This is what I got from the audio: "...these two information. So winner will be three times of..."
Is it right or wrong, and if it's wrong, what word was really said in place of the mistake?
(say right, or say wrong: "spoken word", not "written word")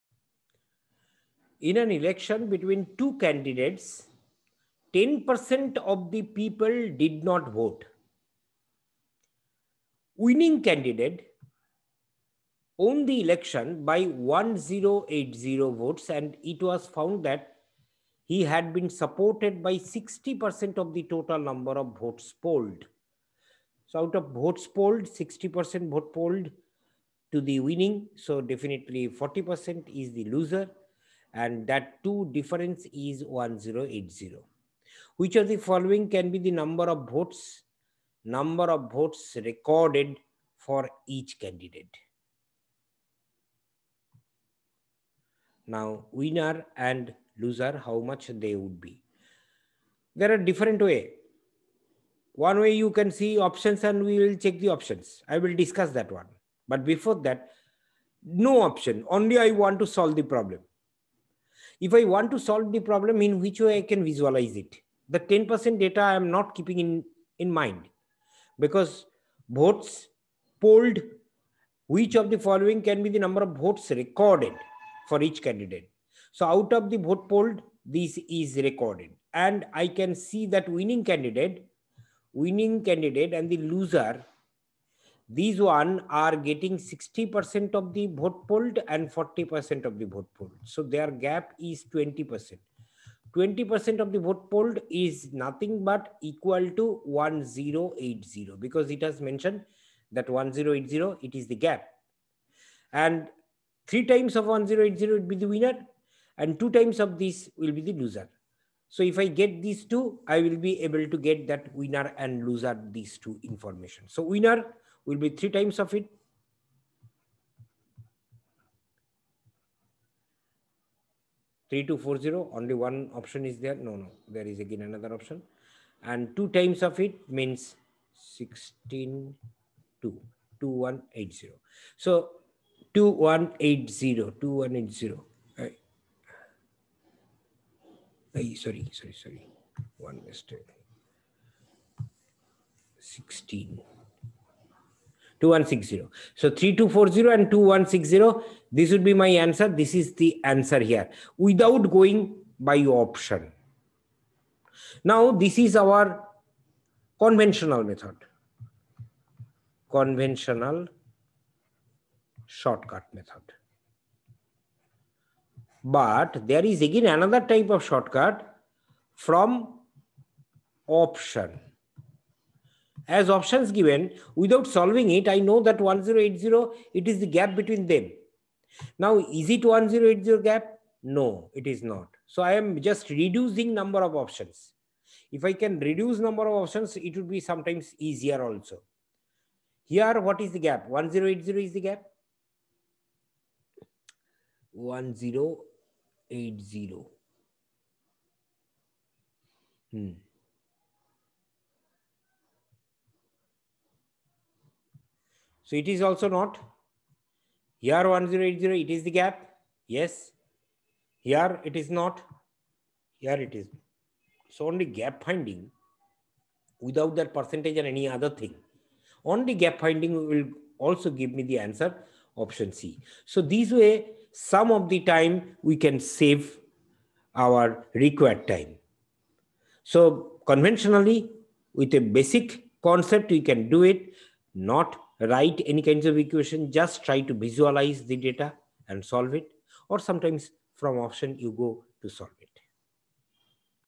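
right.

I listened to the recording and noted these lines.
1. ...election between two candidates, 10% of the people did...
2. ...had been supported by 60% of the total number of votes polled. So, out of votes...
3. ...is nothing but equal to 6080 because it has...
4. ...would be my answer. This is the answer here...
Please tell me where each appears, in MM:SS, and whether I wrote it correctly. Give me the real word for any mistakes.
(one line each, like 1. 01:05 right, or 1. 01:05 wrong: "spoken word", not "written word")
1. 00:01 right
2. 00:18 right
3. 01:34 wrong: "1080", not "6080"
4. 02:28 right.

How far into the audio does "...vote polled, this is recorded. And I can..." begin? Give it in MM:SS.
01:16.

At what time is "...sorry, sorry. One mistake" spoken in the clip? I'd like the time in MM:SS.
02:18.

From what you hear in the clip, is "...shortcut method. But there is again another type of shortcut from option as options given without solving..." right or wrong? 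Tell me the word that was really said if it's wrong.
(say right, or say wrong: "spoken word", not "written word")
right.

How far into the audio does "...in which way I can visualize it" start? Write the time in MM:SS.
01:03.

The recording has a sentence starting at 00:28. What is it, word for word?
So, definitely 40% is the loser and that two difference is 1080.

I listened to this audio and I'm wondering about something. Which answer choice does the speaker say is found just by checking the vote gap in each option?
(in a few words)
Option C.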